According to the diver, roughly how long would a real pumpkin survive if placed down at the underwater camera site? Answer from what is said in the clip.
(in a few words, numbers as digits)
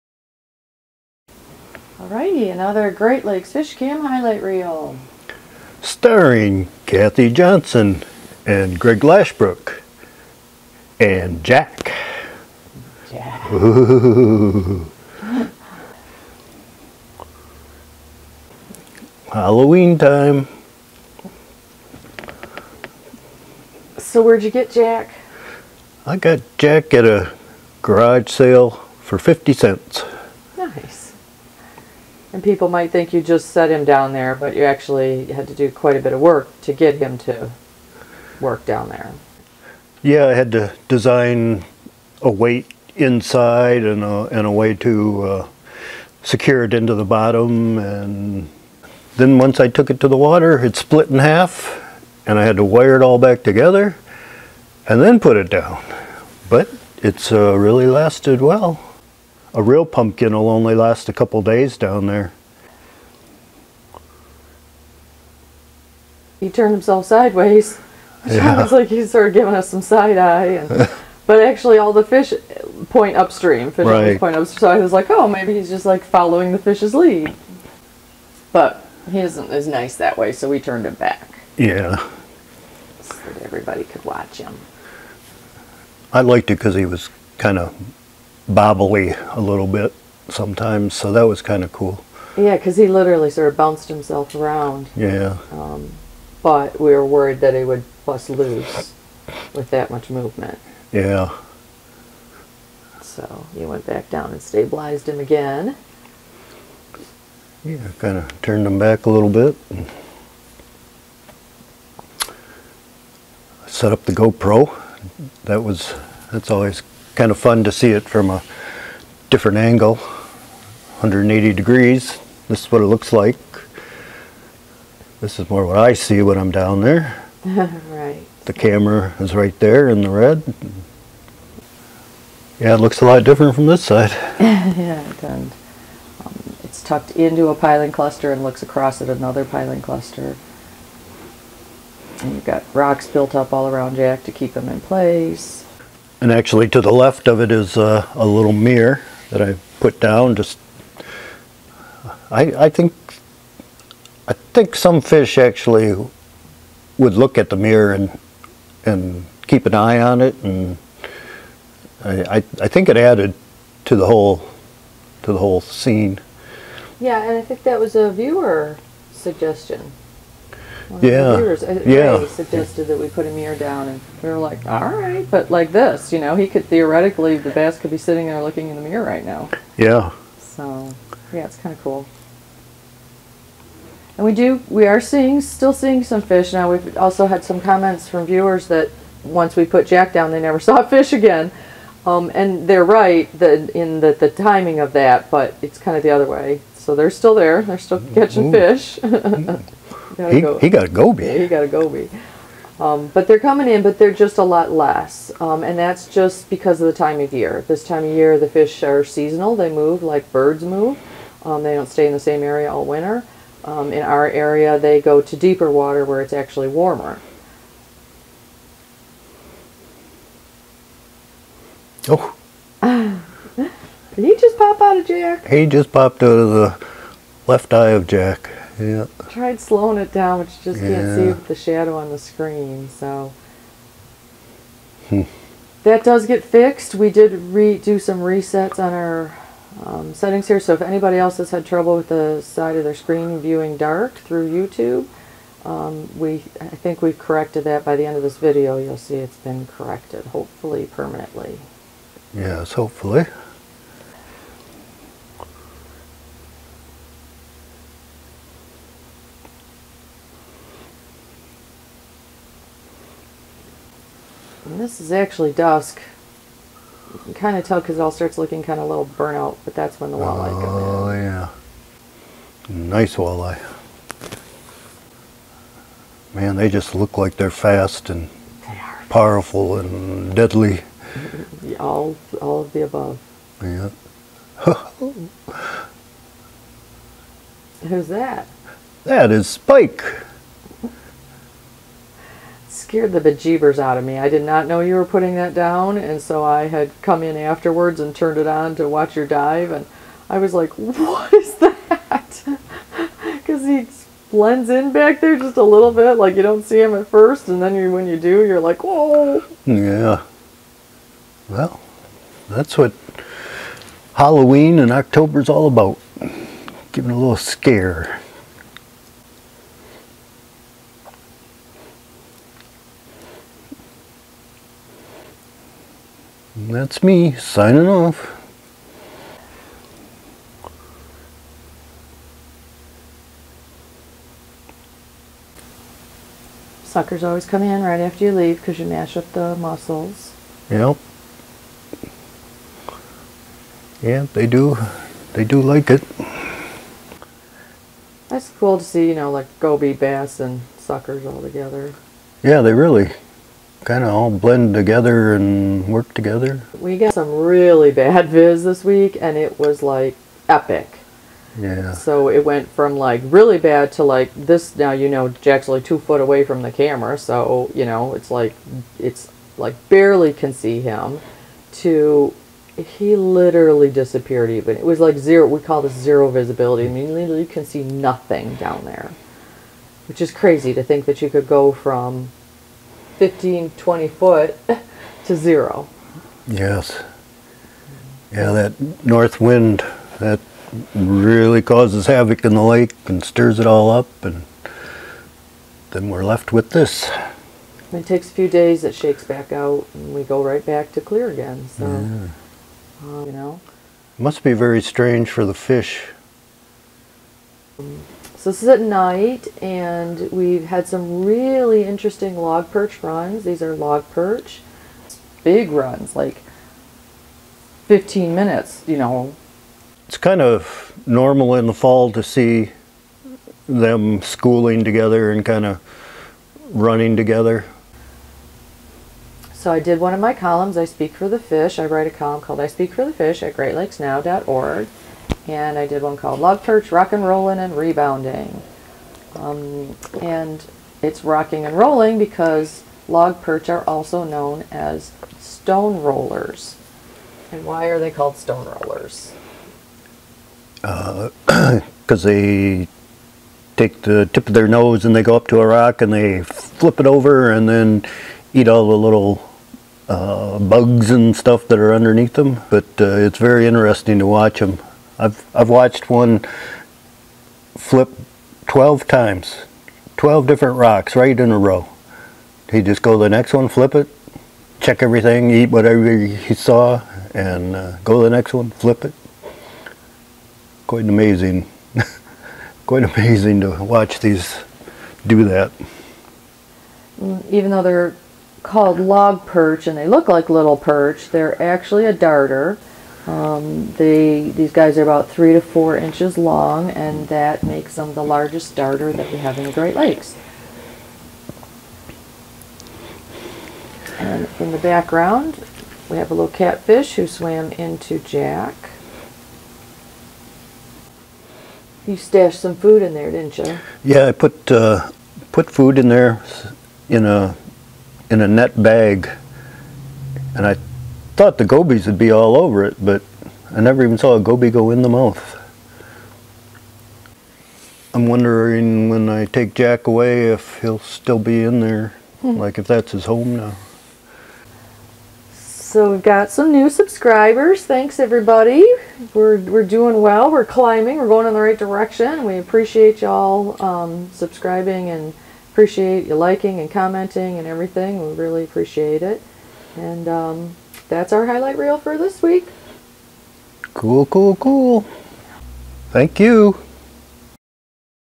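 A couple days.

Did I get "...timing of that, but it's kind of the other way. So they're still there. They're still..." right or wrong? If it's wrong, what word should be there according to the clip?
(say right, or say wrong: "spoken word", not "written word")
right.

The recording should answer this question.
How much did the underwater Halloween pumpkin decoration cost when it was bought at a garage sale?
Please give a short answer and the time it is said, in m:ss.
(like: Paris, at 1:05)
50 cents, at 0:29.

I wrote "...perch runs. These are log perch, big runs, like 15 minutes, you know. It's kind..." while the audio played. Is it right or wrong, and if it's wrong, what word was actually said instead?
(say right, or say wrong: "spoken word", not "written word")
right.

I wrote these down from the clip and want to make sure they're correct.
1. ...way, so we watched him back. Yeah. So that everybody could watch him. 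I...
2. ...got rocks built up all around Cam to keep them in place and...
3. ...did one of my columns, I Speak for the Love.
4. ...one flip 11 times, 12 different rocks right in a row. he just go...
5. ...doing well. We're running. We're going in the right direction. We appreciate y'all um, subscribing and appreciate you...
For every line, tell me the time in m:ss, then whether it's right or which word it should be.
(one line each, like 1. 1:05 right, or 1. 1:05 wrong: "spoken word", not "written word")
1. 1:20 wrong: "turned", not "watched"
2. 2:22 wrong: "Jack", not "Cam"
3. 7:09 wrong: "Fish", not "Love"
4. 7:46 wrong: "12", not "11"
5. 8:59 wrong: "climbing", not "running".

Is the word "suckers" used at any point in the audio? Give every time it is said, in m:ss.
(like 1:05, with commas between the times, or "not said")
5:36, 5:50.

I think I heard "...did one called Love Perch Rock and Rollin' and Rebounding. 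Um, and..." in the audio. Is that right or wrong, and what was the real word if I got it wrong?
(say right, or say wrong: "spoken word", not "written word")
right.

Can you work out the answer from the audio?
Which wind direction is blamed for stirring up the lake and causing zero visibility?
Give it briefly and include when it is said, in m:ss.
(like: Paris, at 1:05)
North, at 6:29.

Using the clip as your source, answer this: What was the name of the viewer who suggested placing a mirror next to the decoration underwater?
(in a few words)
Ray.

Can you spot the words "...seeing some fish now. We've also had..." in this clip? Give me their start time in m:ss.
3:05.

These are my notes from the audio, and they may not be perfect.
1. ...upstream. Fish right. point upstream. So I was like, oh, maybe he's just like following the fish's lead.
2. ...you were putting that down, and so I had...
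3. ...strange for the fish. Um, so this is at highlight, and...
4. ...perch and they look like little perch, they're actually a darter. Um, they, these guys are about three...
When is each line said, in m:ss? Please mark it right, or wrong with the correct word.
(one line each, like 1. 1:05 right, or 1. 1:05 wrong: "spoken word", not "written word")
1. 1:13 right
2. 4:54 right
3. 6:44 wrong: "night", not "highlight"
4. 8:09 right.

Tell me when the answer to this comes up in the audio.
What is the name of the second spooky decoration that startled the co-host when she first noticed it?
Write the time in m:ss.
4:49.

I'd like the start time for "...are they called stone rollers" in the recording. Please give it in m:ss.
7:27.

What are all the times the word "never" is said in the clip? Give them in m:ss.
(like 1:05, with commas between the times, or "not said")
3:10, 8:43.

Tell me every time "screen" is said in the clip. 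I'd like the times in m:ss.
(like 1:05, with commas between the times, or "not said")
3:52, 4:02.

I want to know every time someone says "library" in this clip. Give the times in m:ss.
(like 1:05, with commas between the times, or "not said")
not said.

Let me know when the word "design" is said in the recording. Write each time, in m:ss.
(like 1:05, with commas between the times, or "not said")
0:40.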